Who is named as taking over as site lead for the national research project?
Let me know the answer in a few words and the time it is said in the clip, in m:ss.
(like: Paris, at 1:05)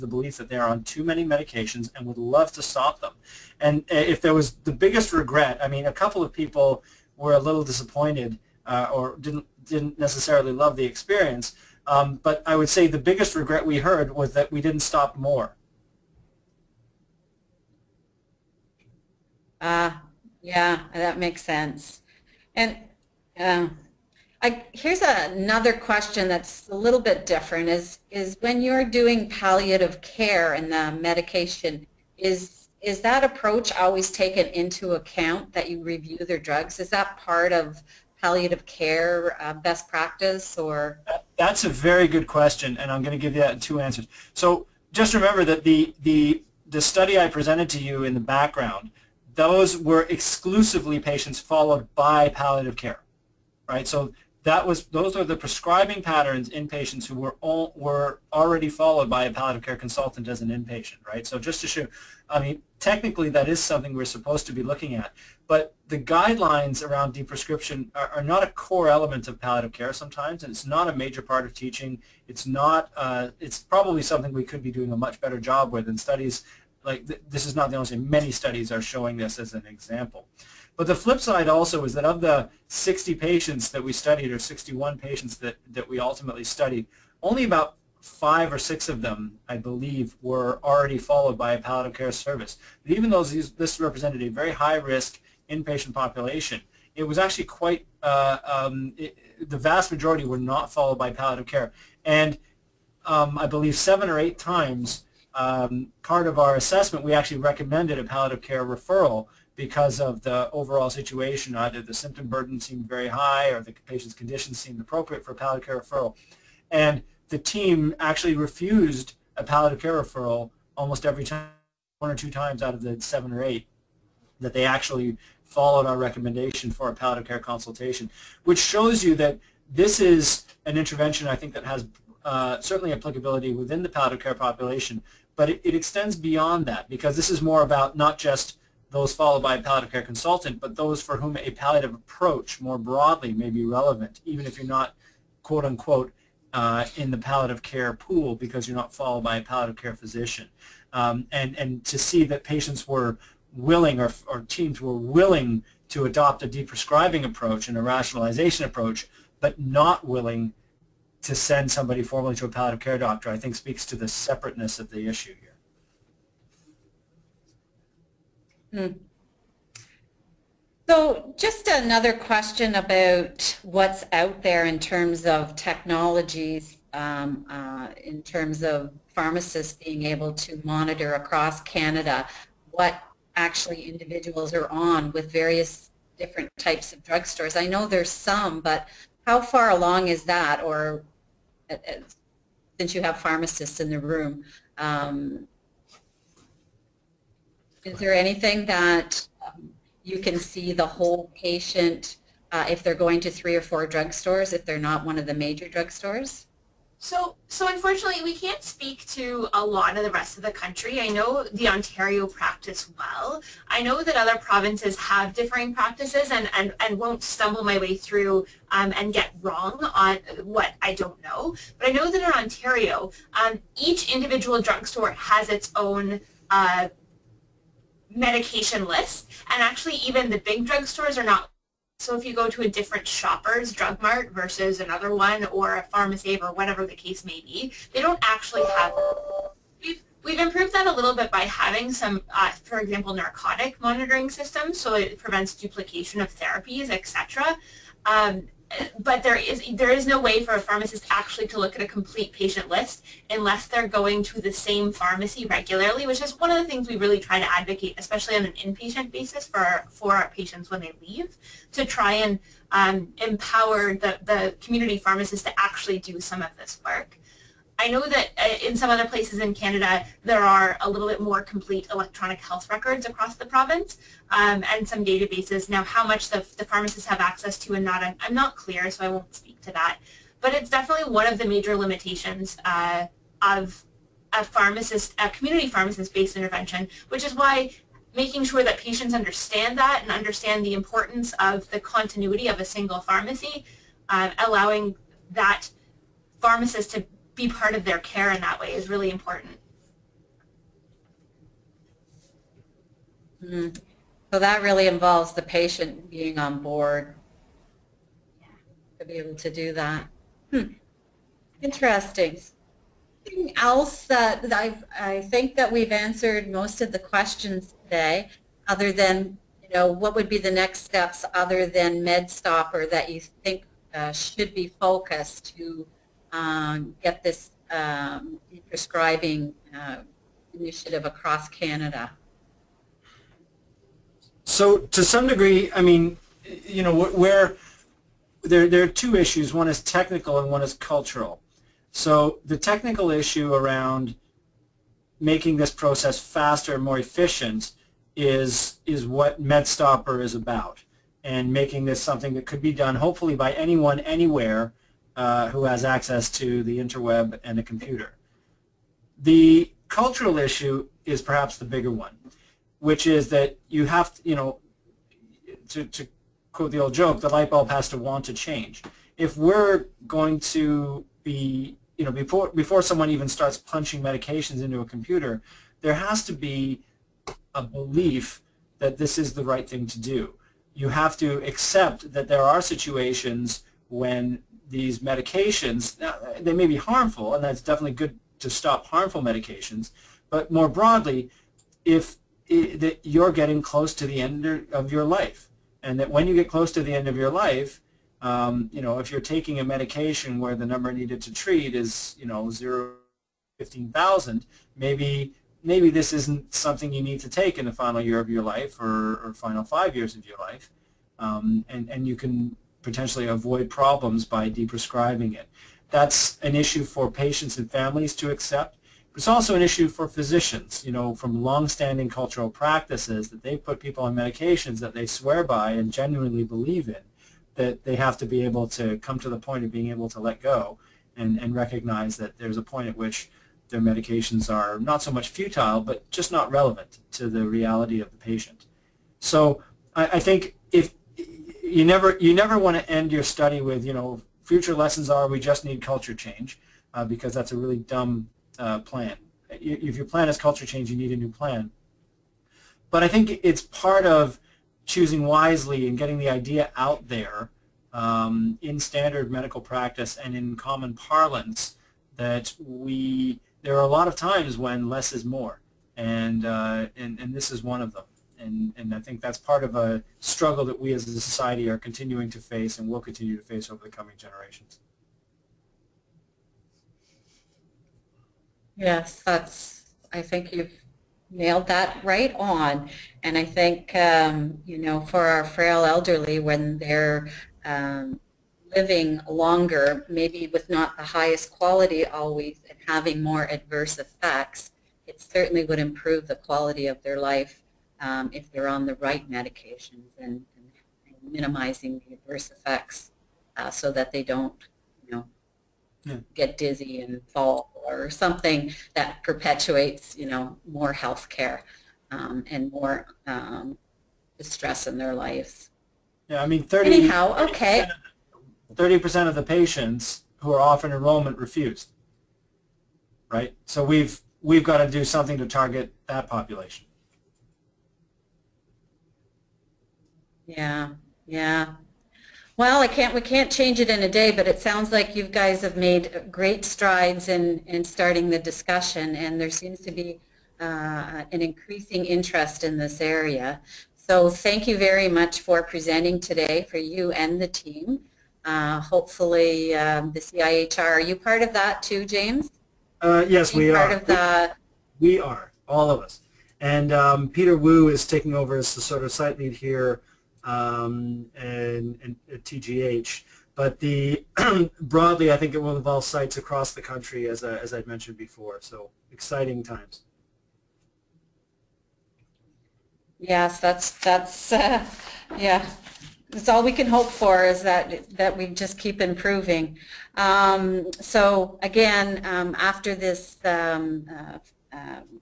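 Peter Wu, at 9:17.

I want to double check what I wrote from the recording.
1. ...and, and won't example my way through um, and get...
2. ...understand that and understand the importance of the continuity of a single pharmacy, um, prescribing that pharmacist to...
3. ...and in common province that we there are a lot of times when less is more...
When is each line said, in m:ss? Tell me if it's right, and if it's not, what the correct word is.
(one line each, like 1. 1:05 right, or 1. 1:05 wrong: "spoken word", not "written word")
1. 3:36 wrong: "stumble", not "example"
2. 4:49 wrong: "allowing", not "prescribing"
3. 7:40 wrong: "parlance", not "province".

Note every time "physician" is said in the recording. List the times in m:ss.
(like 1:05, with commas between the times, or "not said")
2:29, 7:00.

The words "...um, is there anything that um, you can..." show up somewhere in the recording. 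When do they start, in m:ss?
3:14.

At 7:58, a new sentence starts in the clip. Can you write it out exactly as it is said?
Yes, that's, I think you've nailed that right on.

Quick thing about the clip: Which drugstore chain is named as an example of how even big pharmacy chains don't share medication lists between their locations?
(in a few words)
Shoppers Drug Mart.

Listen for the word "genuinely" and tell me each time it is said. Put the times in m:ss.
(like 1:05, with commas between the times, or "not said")
7:05.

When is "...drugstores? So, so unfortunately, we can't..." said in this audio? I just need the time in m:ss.
3:25.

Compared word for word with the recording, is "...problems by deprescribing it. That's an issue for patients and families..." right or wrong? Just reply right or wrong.
right.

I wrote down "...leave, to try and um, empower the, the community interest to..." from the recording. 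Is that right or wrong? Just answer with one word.
wrong.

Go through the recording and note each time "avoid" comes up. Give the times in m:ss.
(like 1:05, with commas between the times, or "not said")
6:53.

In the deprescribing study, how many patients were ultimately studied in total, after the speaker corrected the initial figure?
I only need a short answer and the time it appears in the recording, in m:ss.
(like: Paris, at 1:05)
61, at 1:24.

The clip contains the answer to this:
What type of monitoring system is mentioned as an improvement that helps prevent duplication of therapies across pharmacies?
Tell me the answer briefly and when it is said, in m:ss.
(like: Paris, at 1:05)
narcotic monitoring systems, at 4:03.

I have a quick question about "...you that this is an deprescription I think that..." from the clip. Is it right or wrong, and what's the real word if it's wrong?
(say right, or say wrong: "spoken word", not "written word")
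wrong: "intervention", not "deprescription".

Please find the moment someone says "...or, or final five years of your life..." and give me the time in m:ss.
6:48.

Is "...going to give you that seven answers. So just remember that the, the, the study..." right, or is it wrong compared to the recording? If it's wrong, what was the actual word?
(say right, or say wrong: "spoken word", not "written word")
wrong: "two", not "seven".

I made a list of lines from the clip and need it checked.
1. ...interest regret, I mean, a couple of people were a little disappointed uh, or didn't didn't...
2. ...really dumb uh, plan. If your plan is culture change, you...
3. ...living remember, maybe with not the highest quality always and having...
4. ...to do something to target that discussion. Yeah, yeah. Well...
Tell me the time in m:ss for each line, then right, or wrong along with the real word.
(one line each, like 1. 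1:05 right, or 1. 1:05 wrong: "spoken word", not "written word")
1. 0:04 wrong: "biggest", not "interest"
2. 7:27 right
3. 8:08 wrong: "longer", not "remember"
4. 8:44 wrong: "population", not "discussion".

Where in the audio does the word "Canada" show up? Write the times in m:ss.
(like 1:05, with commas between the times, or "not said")
3:01, 4:29, 5:31.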